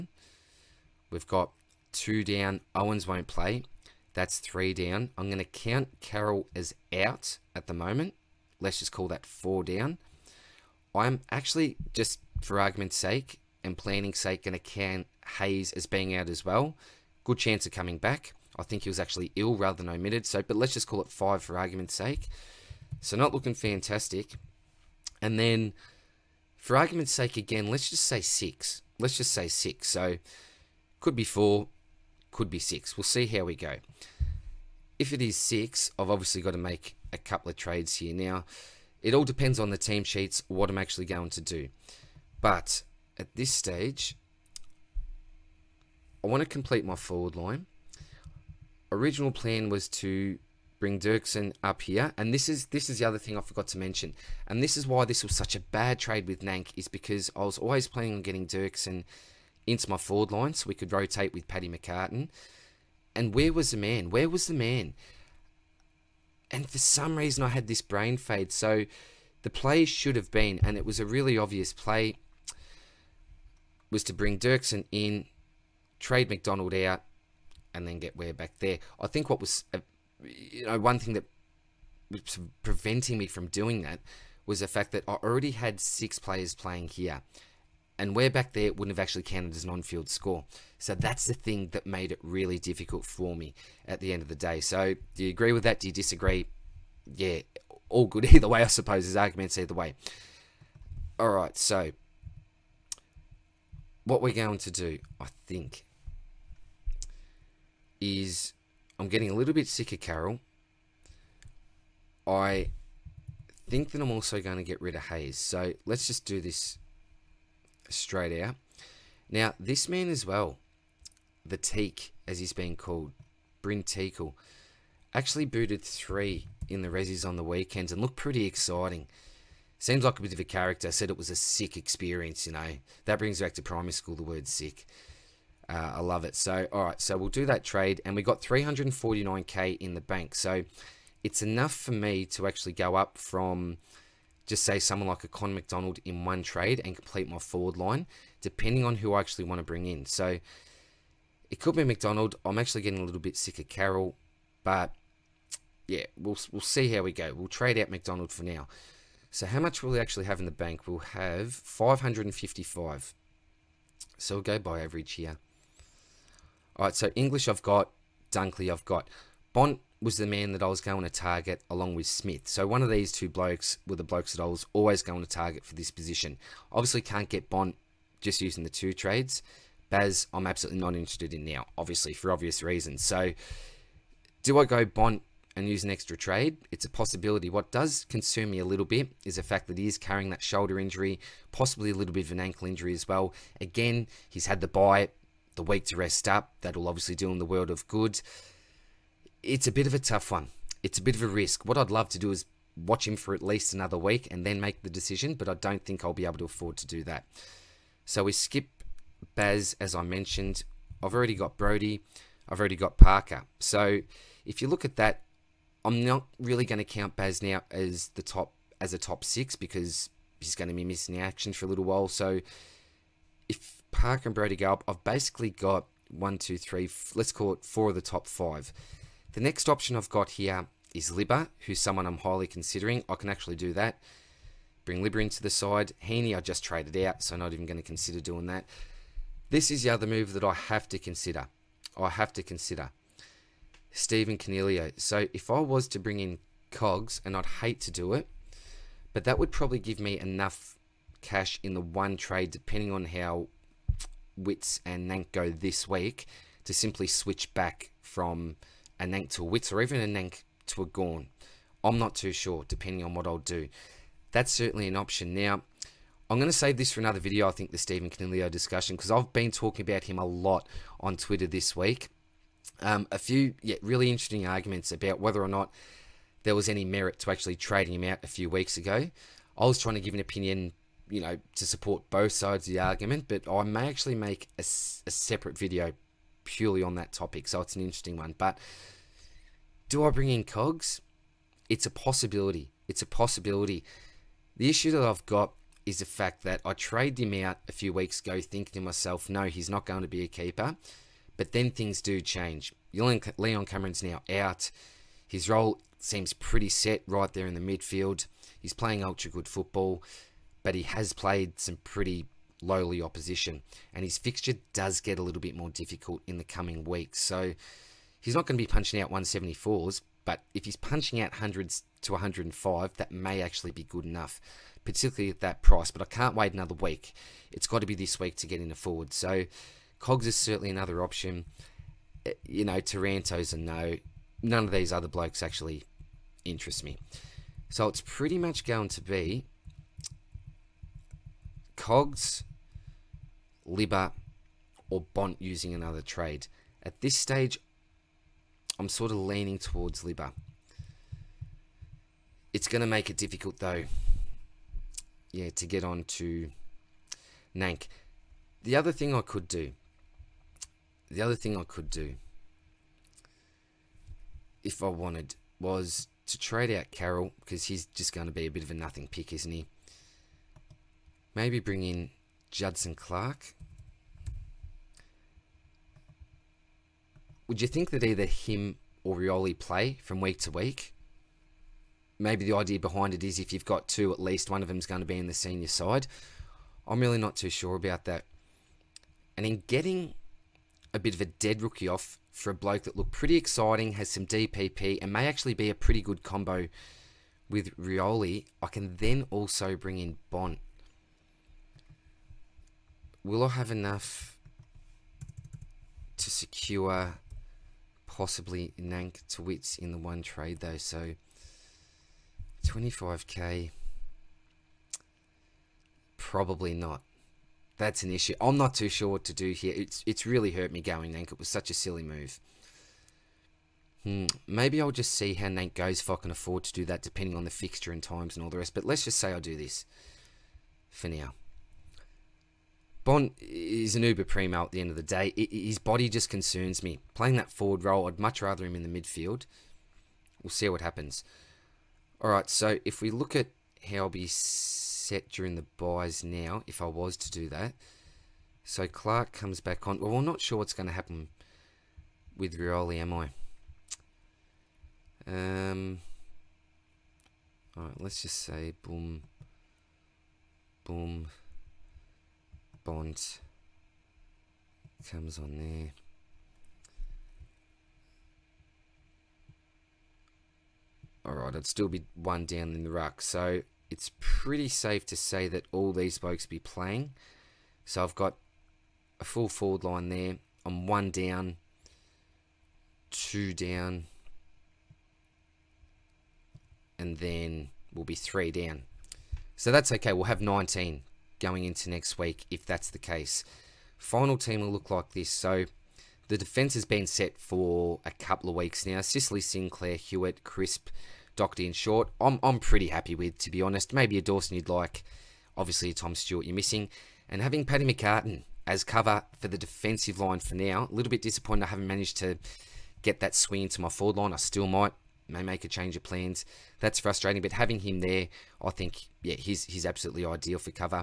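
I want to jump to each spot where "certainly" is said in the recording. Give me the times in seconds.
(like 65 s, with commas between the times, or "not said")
264 s, 330 s.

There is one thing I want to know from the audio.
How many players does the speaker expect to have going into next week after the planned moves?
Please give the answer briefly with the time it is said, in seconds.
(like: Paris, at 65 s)
19, at 490 s.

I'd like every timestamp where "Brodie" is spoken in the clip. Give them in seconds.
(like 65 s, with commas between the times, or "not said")
211 s, 224 s.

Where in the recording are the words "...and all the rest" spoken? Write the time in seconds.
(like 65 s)
428 s.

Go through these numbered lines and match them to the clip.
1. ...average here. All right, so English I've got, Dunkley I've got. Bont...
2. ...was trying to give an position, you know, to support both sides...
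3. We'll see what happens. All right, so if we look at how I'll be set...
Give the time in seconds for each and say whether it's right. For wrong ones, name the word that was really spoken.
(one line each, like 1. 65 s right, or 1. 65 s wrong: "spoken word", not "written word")
1. 164 s right
2. 279 s wrong: "opinion", not "position"
3. 440 s right.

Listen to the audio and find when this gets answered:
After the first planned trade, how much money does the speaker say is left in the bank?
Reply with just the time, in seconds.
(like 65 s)
138 s.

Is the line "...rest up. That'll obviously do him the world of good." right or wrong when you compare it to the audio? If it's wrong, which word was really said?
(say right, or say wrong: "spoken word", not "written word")
right.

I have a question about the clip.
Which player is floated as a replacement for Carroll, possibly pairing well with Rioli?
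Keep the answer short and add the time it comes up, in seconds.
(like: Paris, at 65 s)
Judson Clark, at 372 s.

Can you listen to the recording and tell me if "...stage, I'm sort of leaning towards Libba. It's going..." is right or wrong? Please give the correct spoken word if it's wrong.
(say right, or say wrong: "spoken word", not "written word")
right.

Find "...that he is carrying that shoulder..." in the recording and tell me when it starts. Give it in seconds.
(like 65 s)
189 s.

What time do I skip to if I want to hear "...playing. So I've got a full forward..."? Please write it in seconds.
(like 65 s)
476 s.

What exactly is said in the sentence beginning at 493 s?
Final team will look like this.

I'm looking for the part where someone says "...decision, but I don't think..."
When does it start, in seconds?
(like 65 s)
204 s.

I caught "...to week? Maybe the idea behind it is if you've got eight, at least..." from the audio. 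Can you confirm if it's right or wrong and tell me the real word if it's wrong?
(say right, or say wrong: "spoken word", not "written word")
wrong: "two", not "eight".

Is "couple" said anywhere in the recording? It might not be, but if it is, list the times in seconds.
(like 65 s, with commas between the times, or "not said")
37 s, 498 s.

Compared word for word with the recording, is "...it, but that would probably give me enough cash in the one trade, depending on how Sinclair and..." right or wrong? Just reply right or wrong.
wrong.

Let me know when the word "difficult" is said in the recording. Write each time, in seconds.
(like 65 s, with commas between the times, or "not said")
92 s, 315 s, 353 s.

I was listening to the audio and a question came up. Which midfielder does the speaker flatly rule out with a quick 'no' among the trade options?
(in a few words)
Taranto.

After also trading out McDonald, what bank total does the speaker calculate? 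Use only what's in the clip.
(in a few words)
555.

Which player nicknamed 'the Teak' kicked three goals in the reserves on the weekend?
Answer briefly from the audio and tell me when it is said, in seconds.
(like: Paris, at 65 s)
Bryn Teakle, at 123 s.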